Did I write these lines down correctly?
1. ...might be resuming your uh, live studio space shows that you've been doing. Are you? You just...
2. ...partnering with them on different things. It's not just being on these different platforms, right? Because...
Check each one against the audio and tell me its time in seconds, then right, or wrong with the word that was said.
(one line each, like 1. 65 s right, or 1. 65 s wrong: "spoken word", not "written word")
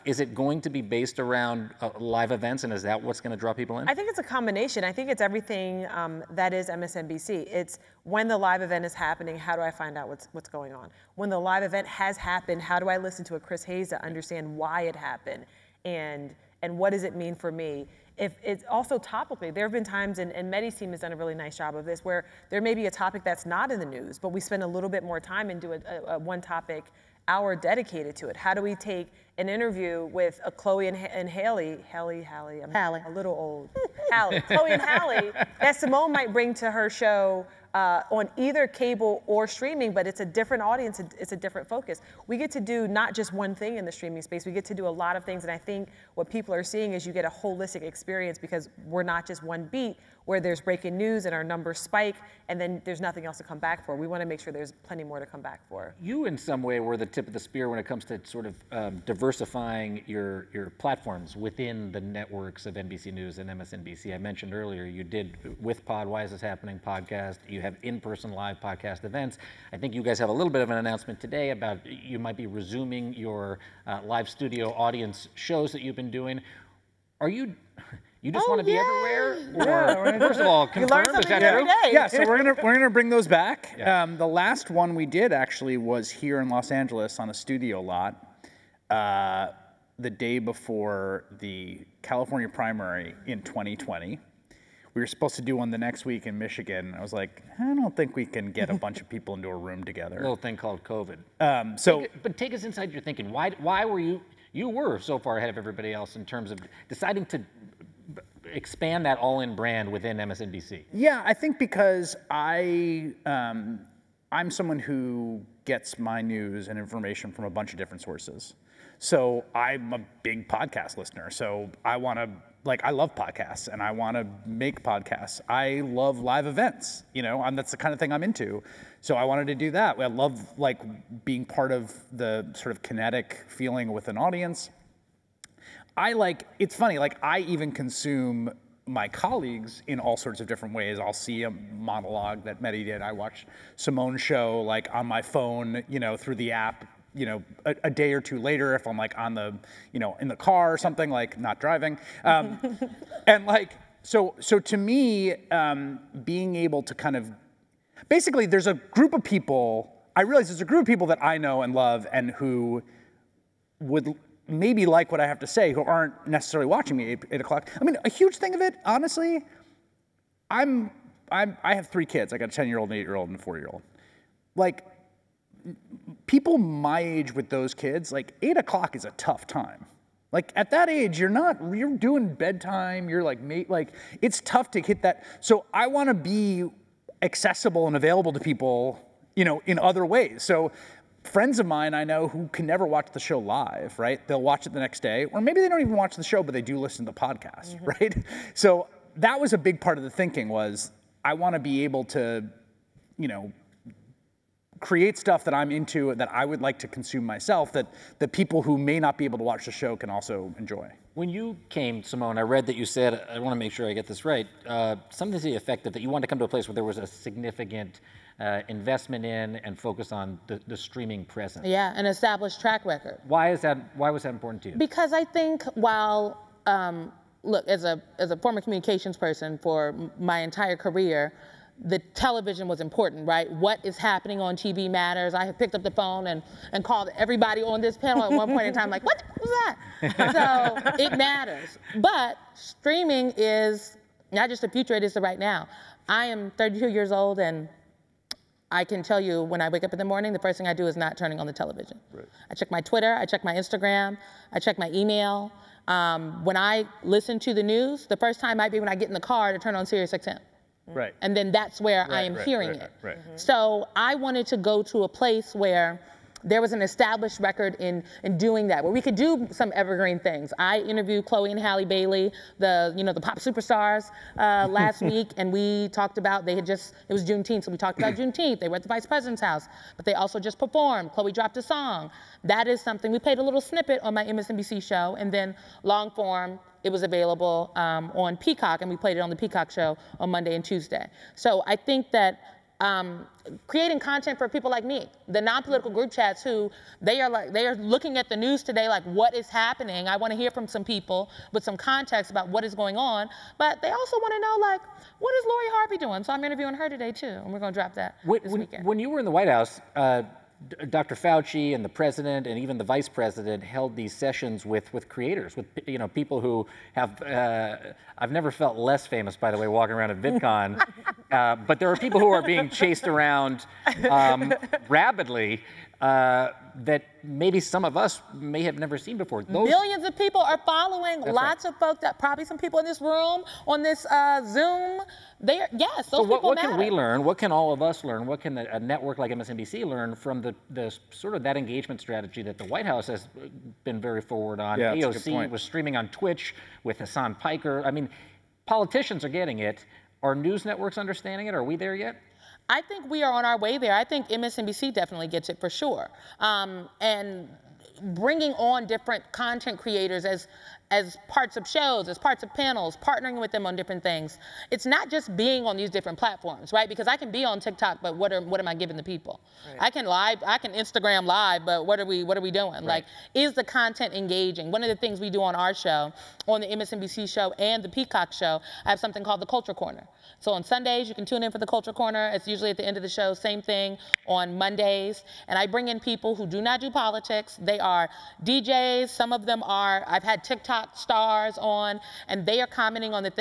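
1. 72 s wrong: "audience", not "space"
2. 362 s right.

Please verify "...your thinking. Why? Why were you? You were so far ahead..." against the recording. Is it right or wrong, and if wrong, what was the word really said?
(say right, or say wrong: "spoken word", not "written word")
right.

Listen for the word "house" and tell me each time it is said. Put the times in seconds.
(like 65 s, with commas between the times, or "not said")
279 s, 309 s, 342 s.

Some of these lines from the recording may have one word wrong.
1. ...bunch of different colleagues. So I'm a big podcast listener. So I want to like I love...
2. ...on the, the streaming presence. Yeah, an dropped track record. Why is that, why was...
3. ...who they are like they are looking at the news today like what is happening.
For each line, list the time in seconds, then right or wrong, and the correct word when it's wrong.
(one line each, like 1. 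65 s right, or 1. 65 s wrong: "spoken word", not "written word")
1. 117 s wrong: "sources", not "colleagues"
2. 220 s wrong: "established", not "dropped"
3. 296 s right.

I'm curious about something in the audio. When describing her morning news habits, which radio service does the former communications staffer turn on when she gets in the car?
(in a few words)
SiriusXM.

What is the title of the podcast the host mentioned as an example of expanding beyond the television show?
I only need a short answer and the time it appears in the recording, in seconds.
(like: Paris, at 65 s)
Why Is This Happening, at 66 s.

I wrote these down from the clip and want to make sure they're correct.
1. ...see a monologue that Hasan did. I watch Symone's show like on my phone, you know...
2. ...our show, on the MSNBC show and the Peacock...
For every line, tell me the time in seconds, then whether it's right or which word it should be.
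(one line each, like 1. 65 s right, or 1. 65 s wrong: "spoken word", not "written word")
1. 141 s wrong: "Mehdi", not "Hasan"
2. 375 s right.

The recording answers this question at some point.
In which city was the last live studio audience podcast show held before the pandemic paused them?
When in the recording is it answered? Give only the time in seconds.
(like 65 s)
86 s.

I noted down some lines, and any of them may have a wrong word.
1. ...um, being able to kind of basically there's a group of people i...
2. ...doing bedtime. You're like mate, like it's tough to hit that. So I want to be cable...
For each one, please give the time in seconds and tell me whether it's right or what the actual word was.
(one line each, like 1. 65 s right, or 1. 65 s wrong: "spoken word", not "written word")
1. 155 s right
2. 181 s wrong: "accessible", not "cable".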